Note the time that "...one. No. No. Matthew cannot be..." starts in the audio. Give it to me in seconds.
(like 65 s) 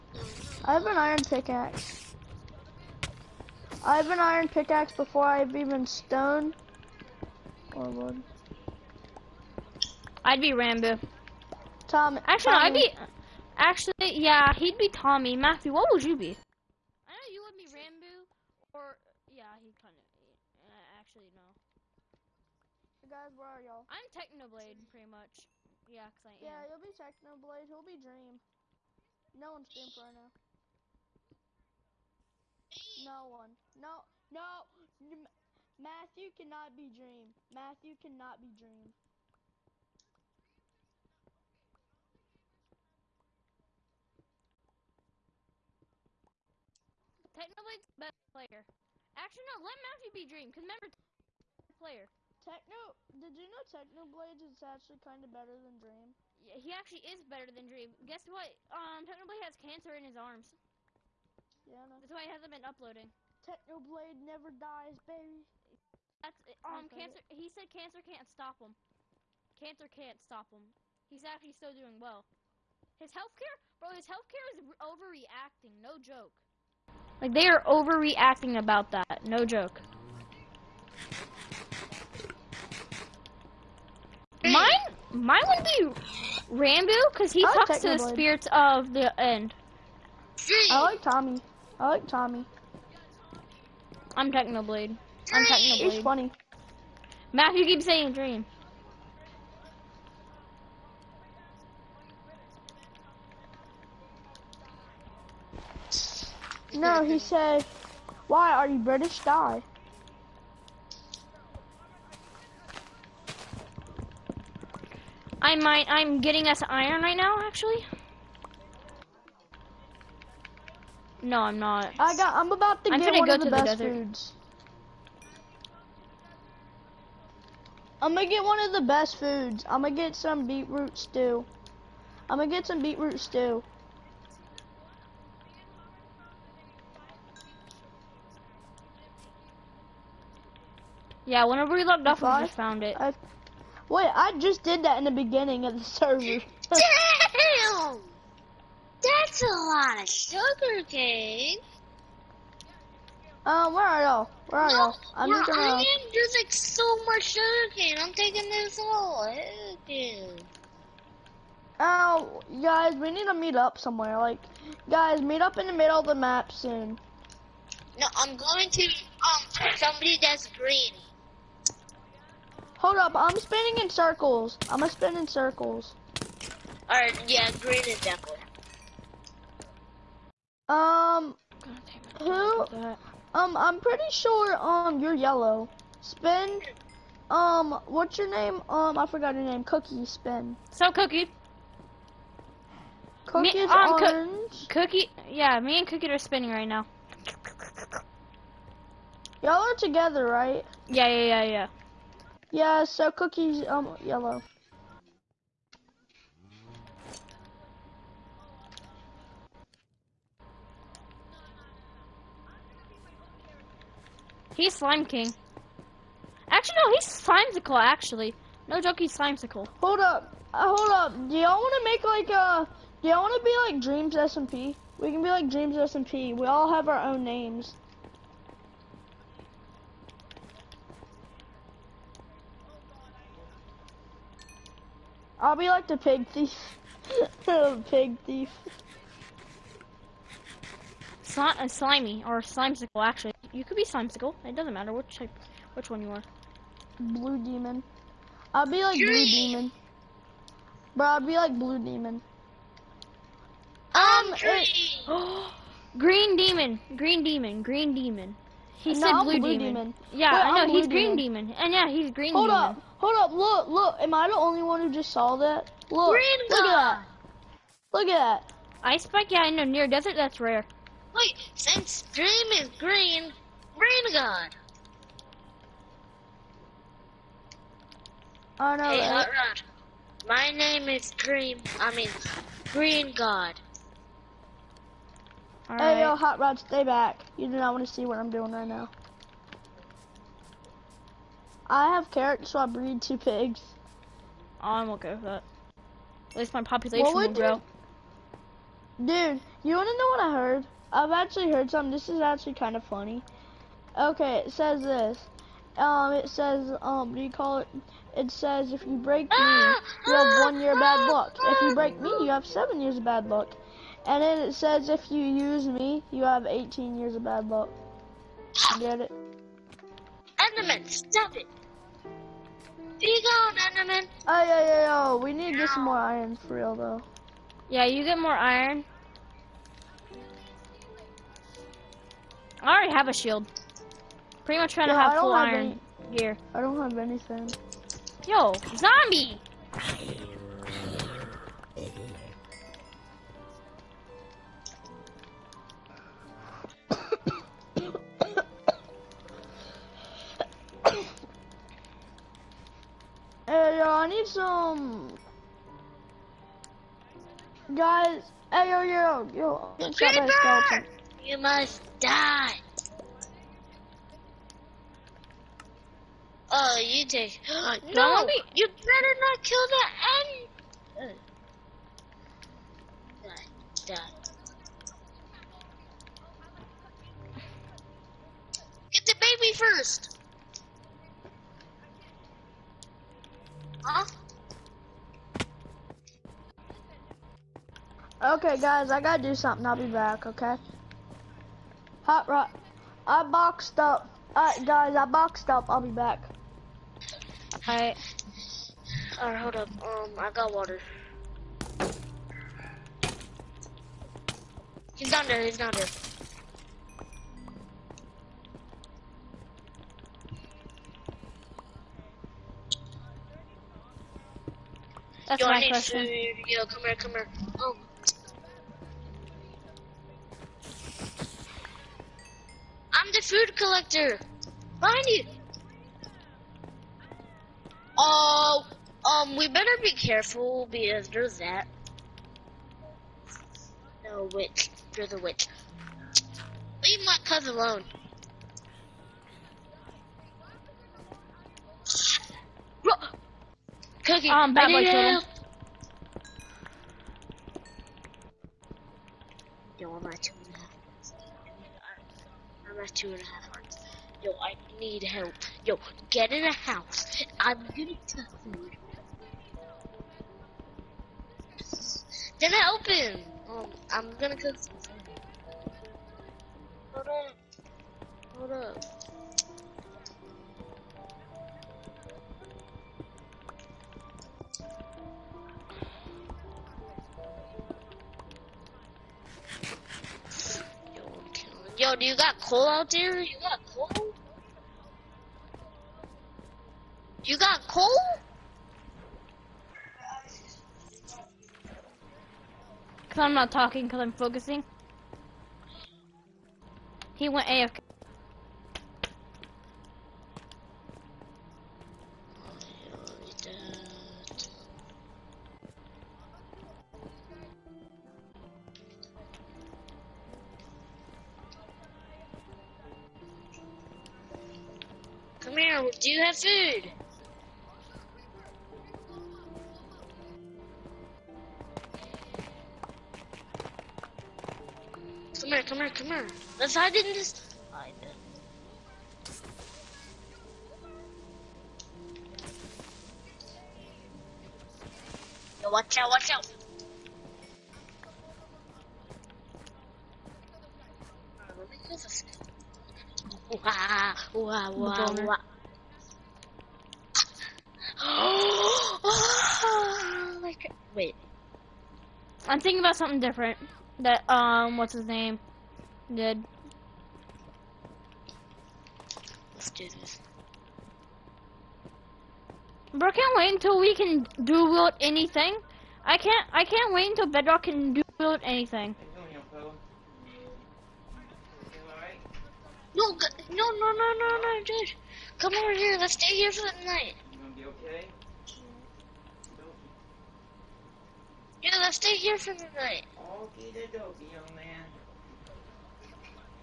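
33 s.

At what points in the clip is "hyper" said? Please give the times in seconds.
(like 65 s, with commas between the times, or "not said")
not said.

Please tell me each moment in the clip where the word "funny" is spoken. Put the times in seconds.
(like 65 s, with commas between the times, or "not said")
96 s, 302 s.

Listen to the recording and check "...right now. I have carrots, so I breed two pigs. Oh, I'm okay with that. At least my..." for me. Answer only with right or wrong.
right.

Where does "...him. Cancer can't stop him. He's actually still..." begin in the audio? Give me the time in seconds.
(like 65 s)
68 s.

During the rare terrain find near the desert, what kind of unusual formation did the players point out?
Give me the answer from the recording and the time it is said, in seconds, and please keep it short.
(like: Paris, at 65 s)
Ice spike, at 268 s.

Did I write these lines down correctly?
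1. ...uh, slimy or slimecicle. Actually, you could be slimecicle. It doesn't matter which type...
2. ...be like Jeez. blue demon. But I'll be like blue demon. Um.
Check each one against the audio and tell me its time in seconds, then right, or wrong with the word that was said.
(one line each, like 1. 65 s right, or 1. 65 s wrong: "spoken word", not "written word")
1. 241 s right
2. 248 s right.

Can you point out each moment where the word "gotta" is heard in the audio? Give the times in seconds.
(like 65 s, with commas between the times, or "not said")
388 s.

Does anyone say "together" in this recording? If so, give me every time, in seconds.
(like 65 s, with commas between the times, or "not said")
199 s.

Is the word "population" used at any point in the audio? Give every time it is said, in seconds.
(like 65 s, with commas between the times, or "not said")
296 s.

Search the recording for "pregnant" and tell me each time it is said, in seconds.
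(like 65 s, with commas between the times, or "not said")
not said.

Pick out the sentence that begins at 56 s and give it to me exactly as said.
Yeah, he actually is better than Dream.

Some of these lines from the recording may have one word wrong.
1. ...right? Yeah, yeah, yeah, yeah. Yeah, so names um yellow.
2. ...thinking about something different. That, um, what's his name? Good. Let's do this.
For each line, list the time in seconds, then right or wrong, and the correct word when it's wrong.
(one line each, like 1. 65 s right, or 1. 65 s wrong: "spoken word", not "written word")
1. 200 s wrong: "cookies", not "names"
2. 552 s right.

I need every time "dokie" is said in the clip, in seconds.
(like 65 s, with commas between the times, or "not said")
583 s.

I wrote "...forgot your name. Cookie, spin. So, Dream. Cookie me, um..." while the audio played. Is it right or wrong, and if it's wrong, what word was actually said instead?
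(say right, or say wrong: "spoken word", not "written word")
wrong: "Cookie", not "Dream".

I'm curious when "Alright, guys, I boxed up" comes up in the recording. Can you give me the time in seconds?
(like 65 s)
394 s.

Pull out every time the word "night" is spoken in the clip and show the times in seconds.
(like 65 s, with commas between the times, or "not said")
576 s, 582 s.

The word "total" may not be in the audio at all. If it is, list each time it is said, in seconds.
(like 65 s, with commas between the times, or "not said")
444 s.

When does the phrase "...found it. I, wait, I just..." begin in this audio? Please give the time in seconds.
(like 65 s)
142 s.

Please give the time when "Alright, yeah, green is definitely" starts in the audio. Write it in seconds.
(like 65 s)
176 s.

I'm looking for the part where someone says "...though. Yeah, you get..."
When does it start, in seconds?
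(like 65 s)
326 s.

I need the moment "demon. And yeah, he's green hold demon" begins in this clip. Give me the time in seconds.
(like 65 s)
261 s.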